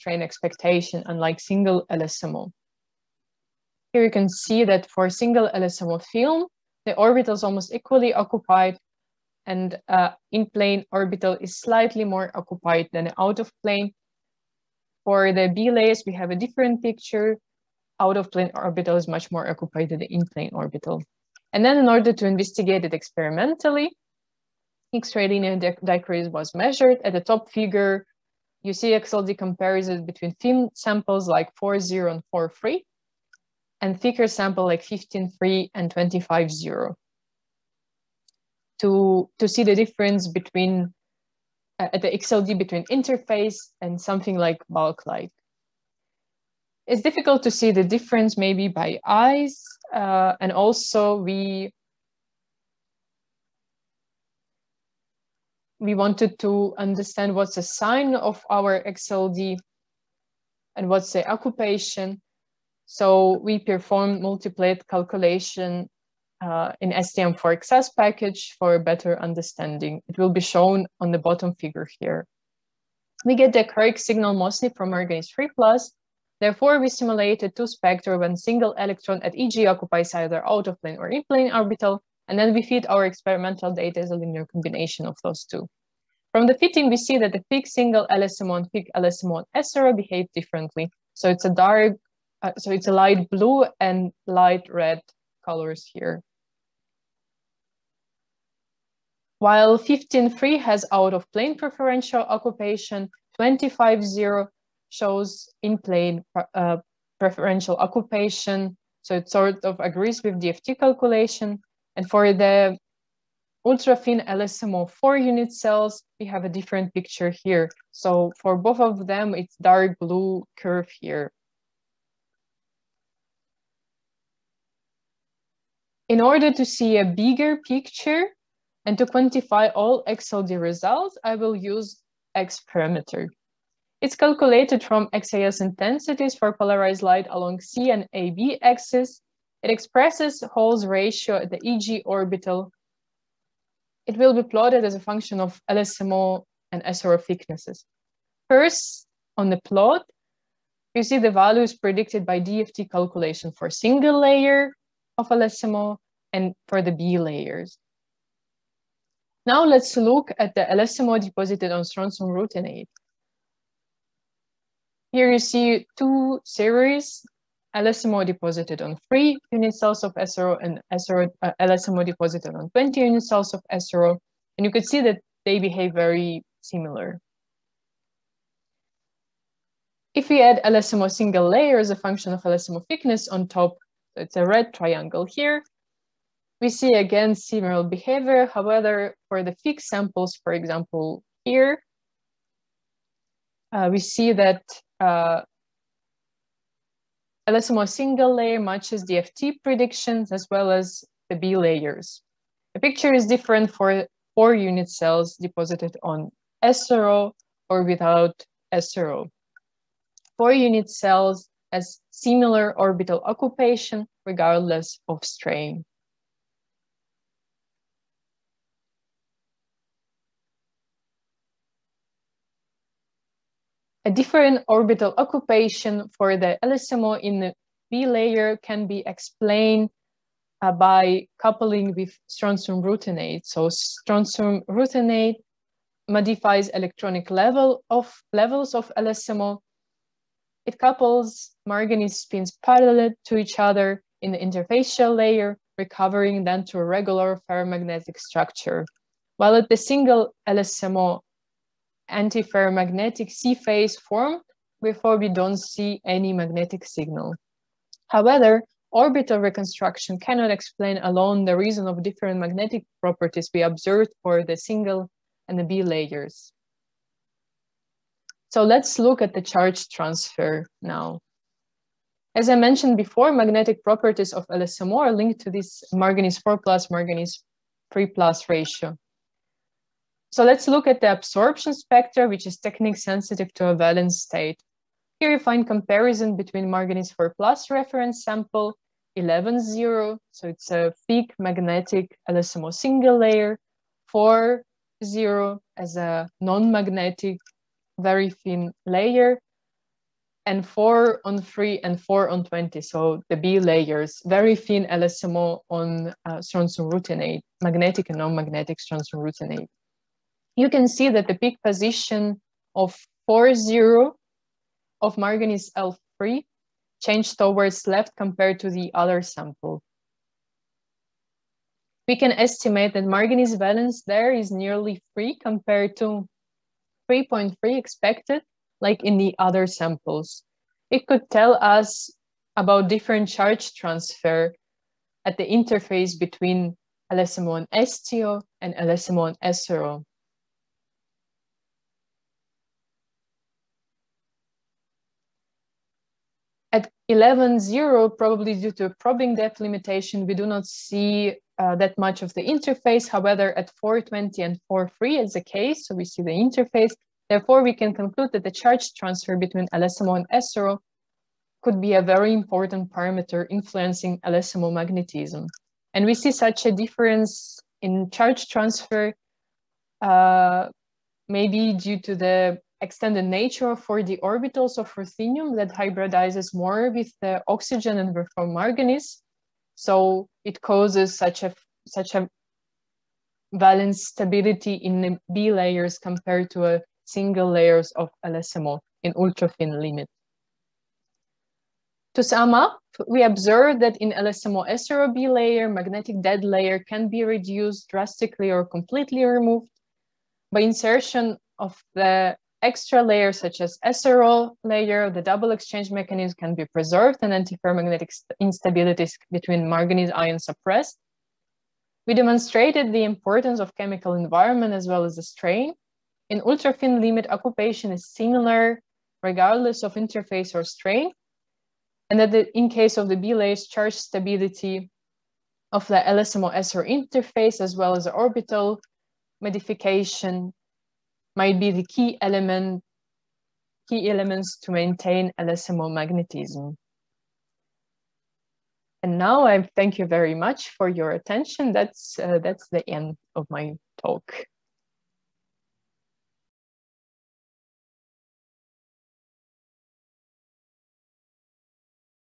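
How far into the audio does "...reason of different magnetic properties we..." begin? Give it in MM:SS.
04:21.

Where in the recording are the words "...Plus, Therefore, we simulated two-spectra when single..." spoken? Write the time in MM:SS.
01:15.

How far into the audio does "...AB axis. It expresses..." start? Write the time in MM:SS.
02:18.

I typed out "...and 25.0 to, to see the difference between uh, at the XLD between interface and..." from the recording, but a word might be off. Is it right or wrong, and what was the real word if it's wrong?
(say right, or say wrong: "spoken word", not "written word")
right.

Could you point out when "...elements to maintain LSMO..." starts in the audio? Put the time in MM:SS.
07:14.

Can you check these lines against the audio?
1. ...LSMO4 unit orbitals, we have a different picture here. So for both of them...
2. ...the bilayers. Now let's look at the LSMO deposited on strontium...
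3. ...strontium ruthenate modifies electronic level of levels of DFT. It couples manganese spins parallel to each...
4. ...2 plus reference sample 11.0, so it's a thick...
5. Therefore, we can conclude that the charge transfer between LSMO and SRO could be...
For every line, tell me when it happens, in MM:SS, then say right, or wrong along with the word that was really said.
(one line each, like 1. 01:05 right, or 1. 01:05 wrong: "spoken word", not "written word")
1. 01:54 wrong: "cells", not "orbitals"
2. 02:36 right
3. 03:53 wrong: "LSMO", not "DFT"
4. 04:47 wrong: "4", not "2"
5. 05:57 right.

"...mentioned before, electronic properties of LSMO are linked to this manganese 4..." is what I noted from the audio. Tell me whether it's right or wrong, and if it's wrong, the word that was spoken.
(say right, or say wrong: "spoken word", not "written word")
wrong: "magnetic", not "electronic".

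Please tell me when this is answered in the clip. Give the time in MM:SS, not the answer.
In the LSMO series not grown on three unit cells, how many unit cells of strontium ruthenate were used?
02:52.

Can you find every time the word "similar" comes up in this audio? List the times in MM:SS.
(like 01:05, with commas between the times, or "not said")
02:56, 03:07, 03:32, 06:58.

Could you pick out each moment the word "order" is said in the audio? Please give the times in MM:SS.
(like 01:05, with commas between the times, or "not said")
00:21, 02:06.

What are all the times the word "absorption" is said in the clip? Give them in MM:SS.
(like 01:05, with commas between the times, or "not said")
04:41.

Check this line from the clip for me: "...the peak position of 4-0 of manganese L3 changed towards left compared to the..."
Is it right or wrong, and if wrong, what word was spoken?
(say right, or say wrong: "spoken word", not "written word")
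right.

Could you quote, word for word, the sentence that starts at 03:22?
The picture is different for four unit cells deposited on SRO or without SRO.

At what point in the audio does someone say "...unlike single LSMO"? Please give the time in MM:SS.
00:01.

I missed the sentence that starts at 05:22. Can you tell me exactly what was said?
We can estimate that manganese valence there is nearly 3 compared to 3.3 expected, like in the other samples.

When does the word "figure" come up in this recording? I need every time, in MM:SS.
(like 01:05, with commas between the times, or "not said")
00:27, 01:11.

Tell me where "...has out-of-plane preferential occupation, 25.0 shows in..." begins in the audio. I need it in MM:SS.
01:40.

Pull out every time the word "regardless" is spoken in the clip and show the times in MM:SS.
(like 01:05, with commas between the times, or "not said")
03:34, 06:59.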